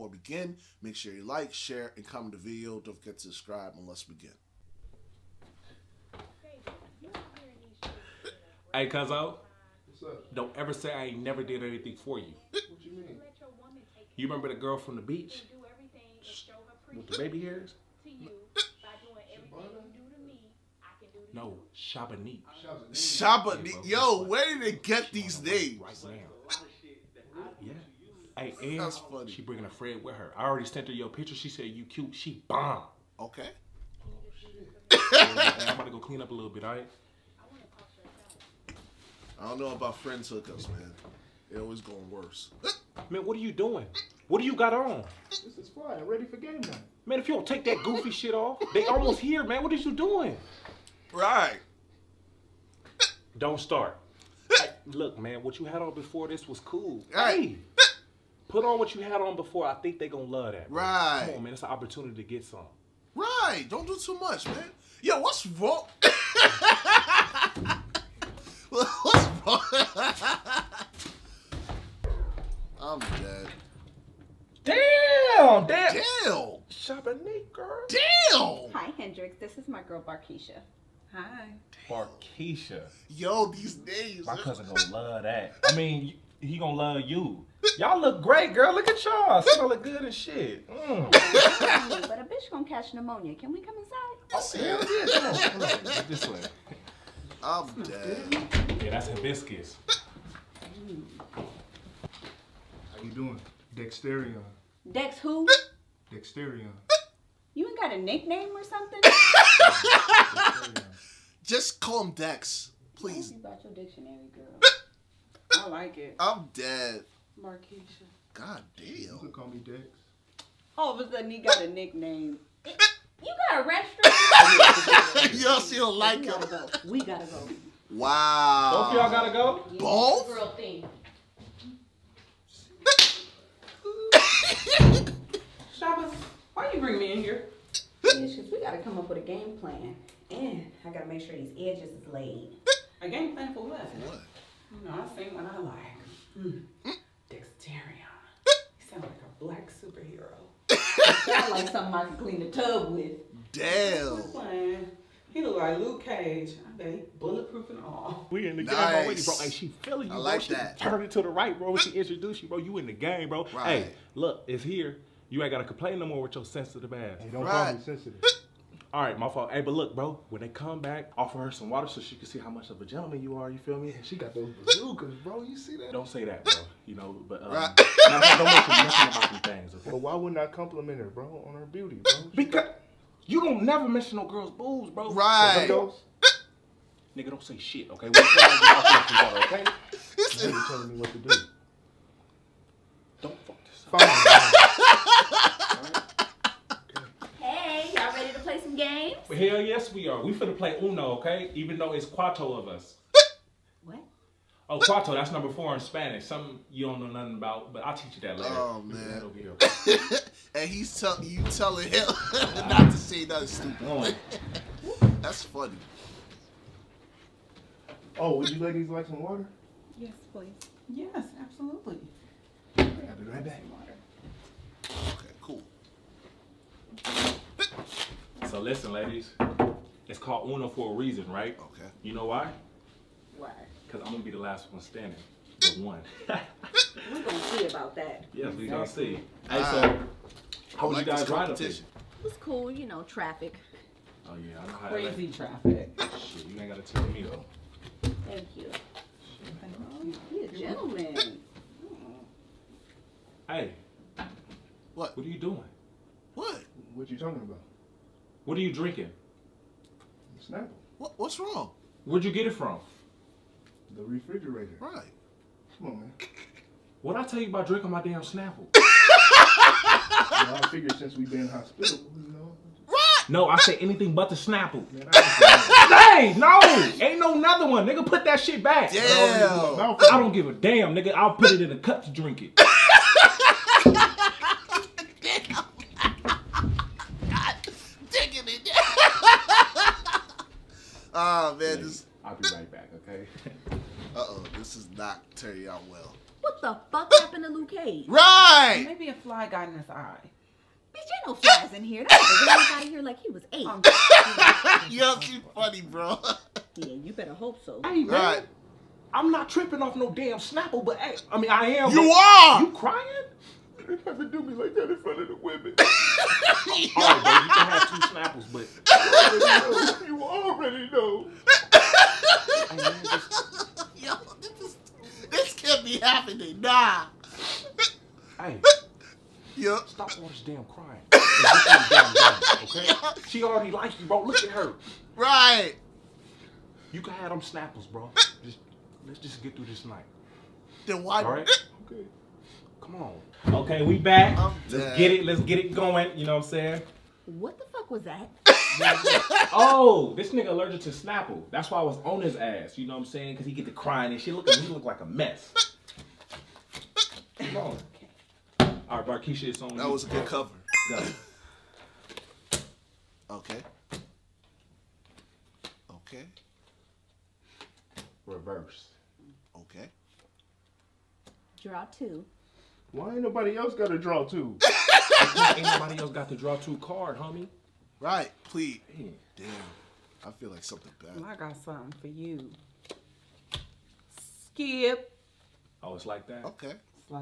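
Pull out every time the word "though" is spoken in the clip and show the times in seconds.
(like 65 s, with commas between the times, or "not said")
201 s, 247 s.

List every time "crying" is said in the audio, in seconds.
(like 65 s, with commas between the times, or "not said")
312 s, 330 s, 353 s.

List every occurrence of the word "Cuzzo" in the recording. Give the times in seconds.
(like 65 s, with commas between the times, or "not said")
8 s.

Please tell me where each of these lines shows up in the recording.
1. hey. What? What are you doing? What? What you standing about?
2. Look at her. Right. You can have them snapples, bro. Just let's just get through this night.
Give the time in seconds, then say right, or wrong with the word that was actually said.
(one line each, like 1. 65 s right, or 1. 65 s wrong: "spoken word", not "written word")
1. 253 s wrong: "talking", not "standing"
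2. 334 s right.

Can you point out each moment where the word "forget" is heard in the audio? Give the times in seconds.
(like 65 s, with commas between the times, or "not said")
2 s.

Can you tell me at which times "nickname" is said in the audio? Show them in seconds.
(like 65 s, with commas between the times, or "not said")
107 s, 121 s.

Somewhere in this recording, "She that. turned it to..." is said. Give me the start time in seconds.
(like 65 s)
160 s.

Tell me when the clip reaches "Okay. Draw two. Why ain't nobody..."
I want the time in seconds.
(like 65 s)
369 s.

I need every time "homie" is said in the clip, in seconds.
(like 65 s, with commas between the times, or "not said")
377 s.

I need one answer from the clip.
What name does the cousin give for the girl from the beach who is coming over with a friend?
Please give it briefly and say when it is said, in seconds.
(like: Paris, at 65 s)
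Shabani, at 21 s.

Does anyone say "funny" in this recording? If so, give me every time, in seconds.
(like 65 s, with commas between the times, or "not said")
28 s, 215 s, 305 s.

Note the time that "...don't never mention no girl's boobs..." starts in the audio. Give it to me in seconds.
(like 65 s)
183 s.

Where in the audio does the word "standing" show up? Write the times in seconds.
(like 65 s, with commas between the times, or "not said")
234 s.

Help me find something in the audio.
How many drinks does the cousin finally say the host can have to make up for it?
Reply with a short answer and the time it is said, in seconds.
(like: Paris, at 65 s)
2, at 317 s.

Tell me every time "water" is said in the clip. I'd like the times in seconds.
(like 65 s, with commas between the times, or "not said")
171 s, 219 s.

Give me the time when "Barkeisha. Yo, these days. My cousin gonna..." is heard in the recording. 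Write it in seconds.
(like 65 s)
81 s.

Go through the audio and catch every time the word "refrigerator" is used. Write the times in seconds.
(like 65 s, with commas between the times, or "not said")
264 s.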